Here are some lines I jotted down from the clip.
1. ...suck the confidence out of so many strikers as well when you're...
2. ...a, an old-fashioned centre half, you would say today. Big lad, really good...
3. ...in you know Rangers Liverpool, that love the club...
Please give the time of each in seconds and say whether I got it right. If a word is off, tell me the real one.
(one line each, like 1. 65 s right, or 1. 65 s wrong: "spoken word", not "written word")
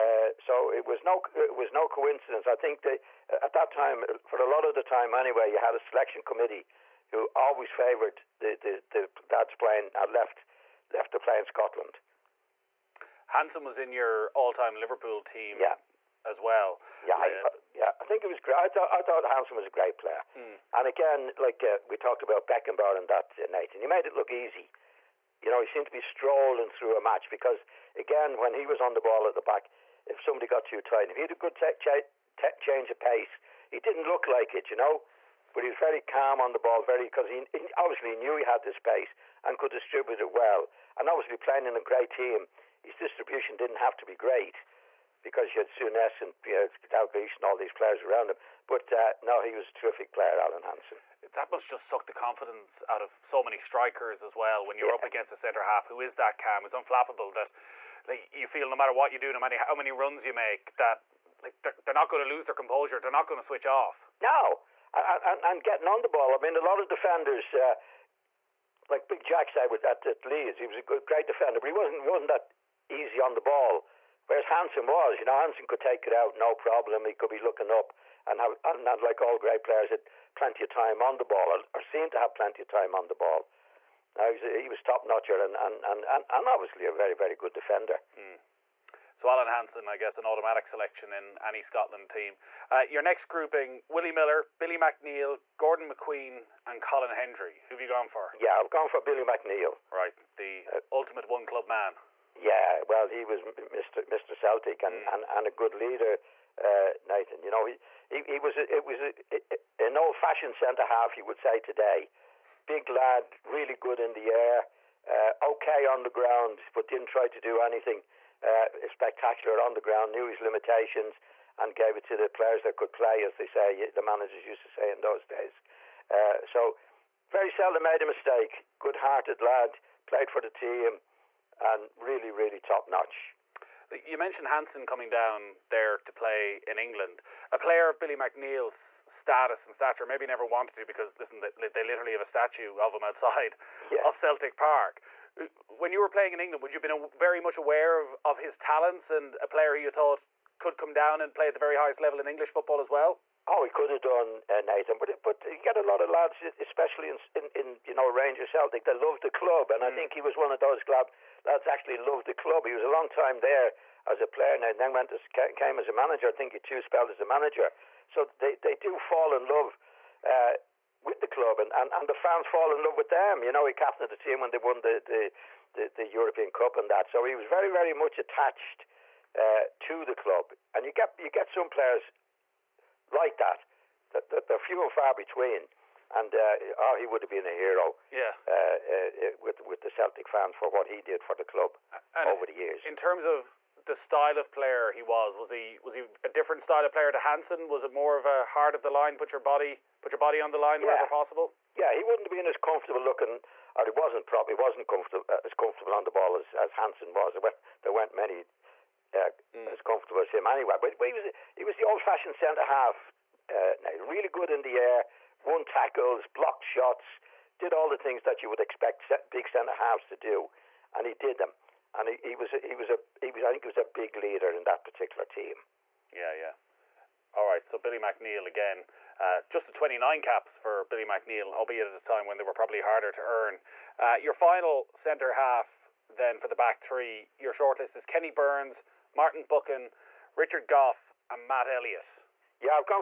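1. 51 s right
2. 109 s right
3. 157 s wrong: "Celtic", not "Liverpool".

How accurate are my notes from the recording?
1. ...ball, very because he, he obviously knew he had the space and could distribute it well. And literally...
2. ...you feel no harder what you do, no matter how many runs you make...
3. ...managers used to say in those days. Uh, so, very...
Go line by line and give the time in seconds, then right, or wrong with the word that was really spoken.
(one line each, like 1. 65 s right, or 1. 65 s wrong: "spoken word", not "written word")
1. 36 s wrong: "obviously", not "literally"
2. 58 s wrong: "matter", not "harder"
3. 124 s right.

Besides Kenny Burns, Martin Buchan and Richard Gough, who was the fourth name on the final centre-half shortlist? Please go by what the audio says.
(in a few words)
Matt Elliott.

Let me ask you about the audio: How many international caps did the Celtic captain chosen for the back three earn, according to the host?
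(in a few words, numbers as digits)
29.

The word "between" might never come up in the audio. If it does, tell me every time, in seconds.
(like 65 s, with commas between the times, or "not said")
185 s.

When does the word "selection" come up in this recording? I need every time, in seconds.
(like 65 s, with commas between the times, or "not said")
5 s, 90 s.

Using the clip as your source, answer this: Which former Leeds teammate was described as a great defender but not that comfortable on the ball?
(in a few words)
Big Jack.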